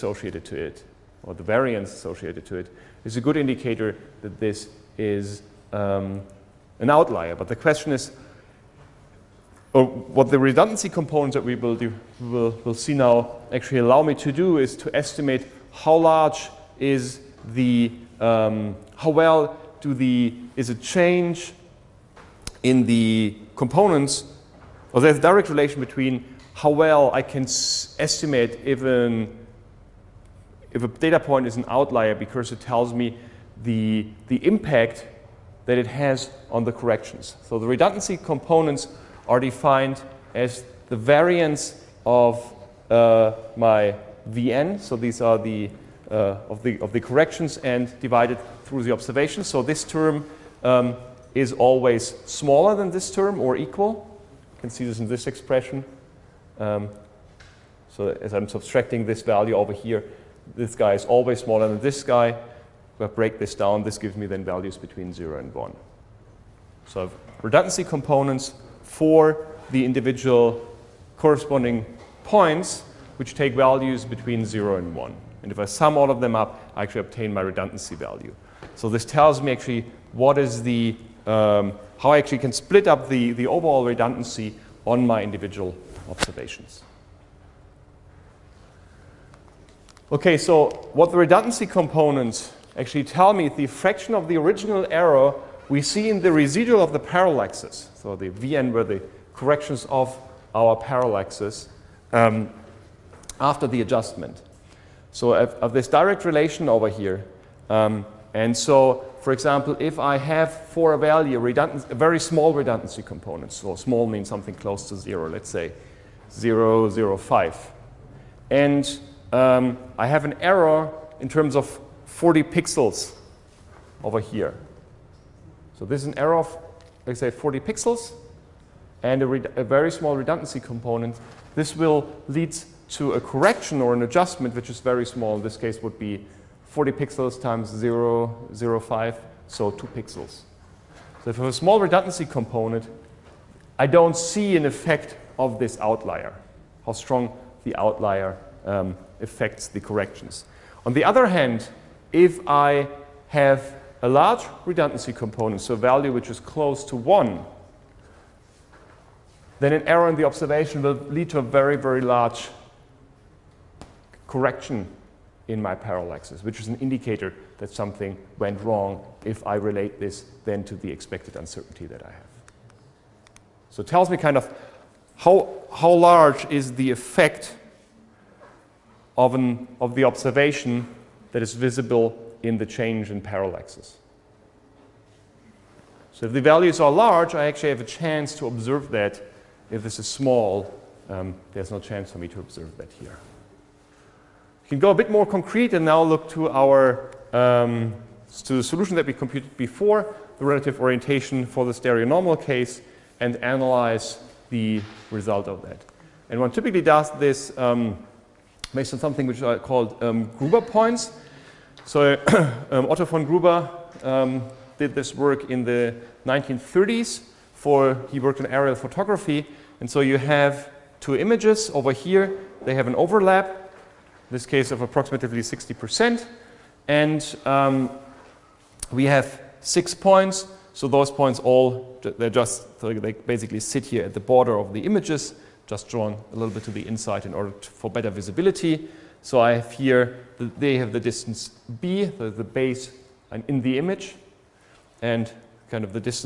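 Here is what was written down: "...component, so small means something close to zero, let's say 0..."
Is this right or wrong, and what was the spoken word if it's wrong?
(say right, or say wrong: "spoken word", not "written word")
right.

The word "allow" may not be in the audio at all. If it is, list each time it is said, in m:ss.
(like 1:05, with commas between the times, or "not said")
0:13.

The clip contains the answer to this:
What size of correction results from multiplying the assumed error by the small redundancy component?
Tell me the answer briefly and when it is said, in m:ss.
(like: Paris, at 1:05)
2 pixels, at 2:19.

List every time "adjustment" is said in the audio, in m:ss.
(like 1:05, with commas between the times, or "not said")
1:43, 2:14.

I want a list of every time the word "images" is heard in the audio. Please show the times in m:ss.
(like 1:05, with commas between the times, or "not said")
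3:41, 3:54, 4:03.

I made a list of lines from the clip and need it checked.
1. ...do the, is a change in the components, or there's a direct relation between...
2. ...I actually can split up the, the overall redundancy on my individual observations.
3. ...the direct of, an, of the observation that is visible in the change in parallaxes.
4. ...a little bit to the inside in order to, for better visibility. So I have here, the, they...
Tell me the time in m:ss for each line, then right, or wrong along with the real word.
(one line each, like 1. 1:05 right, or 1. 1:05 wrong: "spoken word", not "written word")
1. 0:19 right
2. 1:22 right
3. 2:56 wrong: "effect", not "direct"
4. 3:56 right.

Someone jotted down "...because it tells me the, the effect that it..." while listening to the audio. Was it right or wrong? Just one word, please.
wrong.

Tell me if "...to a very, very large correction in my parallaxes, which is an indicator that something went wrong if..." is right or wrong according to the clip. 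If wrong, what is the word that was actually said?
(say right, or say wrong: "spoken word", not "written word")
right.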